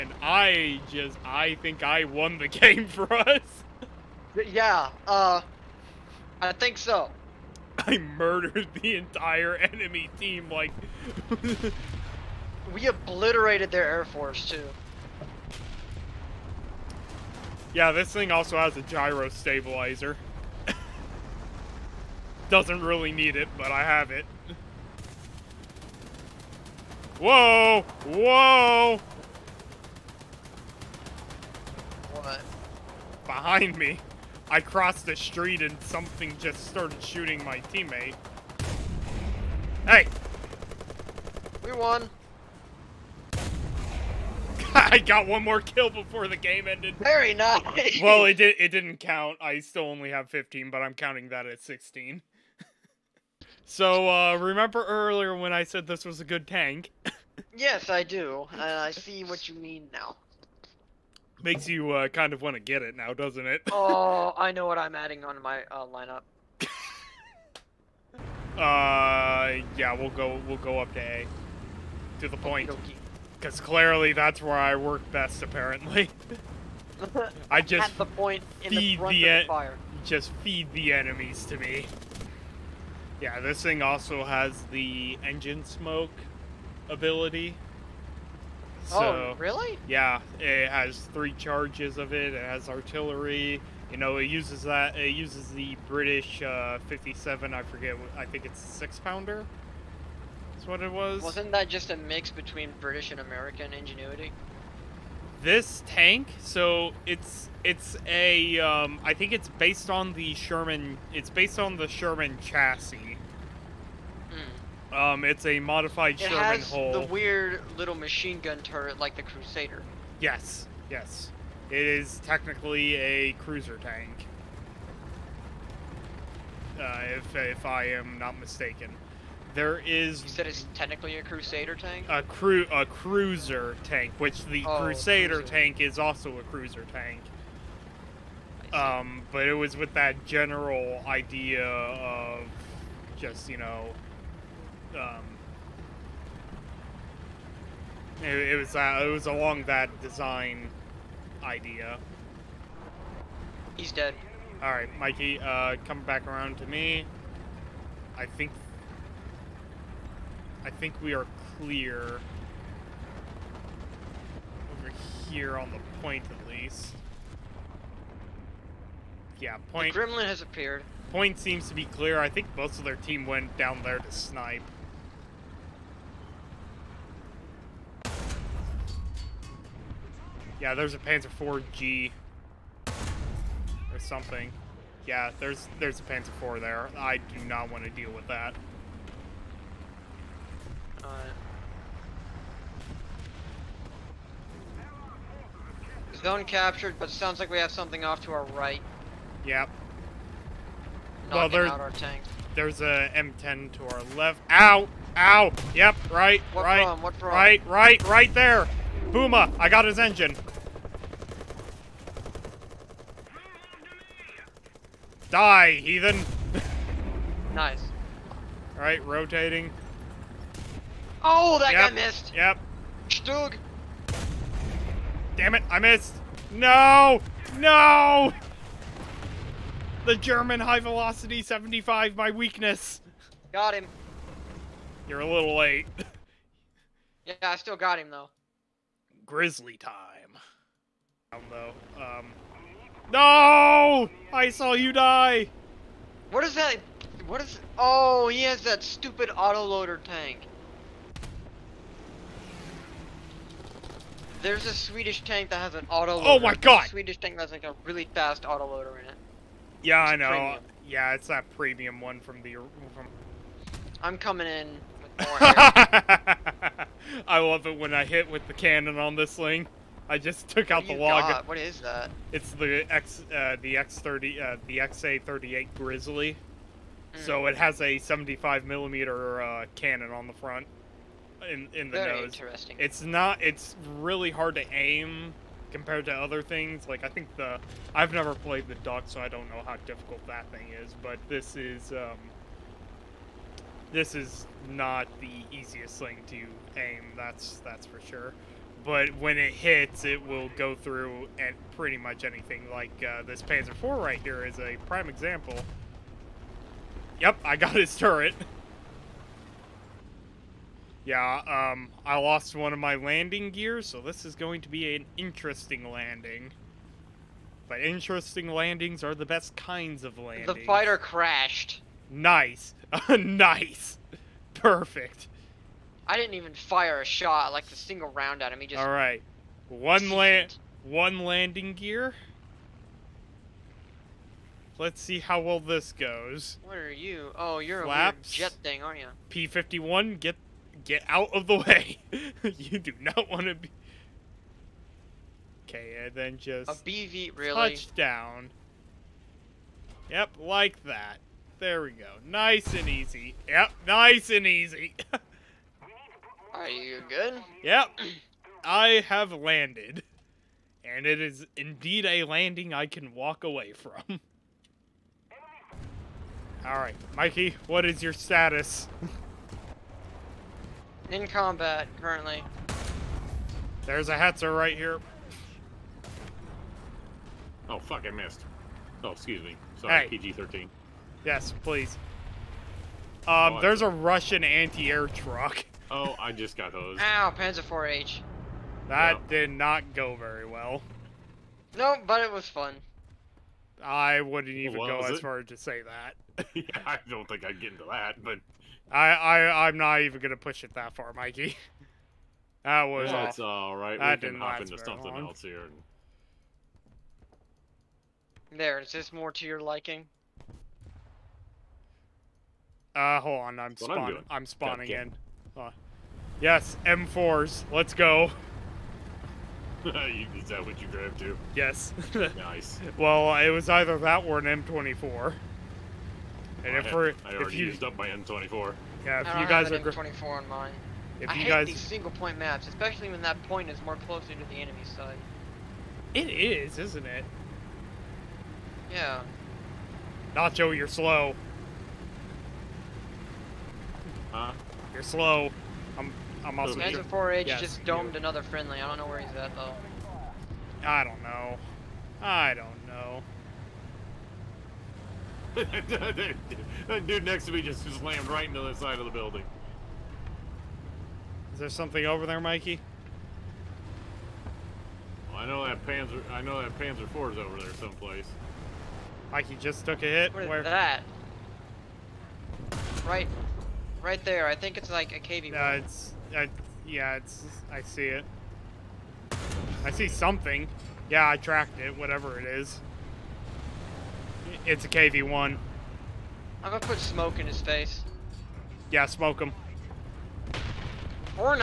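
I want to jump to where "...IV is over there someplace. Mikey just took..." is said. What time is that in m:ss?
7:47.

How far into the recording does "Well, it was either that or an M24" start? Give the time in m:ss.
7:02.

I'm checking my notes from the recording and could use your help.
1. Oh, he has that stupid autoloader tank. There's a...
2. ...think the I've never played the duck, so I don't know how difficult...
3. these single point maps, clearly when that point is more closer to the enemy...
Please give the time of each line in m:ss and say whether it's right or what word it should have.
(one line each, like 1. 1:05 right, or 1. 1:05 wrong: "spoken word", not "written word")
1. 4:07 right
2. 4:47 right
3. 7:11 wrong: "especially", not "clearly".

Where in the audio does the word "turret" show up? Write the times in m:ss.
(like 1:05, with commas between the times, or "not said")
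1:58, 5:07.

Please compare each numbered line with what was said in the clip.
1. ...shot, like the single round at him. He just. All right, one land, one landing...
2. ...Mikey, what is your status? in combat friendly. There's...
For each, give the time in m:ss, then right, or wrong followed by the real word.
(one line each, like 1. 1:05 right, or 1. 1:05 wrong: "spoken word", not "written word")
1. 5:27 right
2. 6:07 wrong: "currently", not "friendly".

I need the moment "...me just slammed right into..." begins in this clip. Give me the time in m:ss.
7:37.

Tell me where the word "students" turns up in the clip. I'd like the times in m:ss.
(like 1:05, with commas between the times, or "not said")
not said.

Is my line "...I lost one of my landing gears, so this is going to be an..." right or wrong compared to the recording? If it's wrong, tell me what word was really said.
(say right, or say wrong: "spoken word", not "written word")
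right.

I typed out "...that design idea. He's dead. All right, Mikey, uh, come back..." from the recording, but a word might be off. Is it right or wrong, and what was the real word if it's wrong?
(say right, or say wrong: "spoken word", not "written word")
right.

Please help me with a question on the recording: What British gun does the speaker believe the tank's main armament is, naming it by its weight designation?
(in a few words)
six pounder.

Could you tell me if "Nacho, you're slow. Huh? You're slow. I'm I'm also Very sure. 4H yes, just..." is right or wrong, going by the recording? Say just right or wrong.
wrong.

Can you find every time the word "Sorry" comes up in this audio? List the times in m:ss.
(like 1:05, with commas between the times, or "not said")
6:19.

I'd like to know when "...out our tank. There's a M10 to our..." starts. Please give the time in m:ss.
3:21.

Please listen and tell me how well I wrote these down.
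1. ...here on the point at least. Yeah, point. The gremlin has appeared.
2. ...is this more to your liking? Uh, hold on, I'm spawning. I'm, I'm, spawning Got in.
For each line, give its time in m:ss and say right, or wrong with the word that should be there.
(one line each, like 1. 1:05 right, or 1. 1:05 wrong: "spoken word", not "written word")
1. 2:45 right
2. 6:48 right.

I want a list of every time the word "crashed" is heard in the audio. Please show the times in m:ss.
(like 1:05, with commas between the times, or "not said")
5:20.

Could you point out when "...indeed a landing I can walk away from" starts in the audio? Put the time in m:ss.
6:01.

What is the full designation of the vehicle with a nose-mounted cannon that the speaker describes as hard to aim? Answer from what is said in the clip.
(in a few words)
XA38 Grizzly.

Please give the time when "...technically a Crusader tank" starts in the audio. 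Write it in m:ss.
2:10.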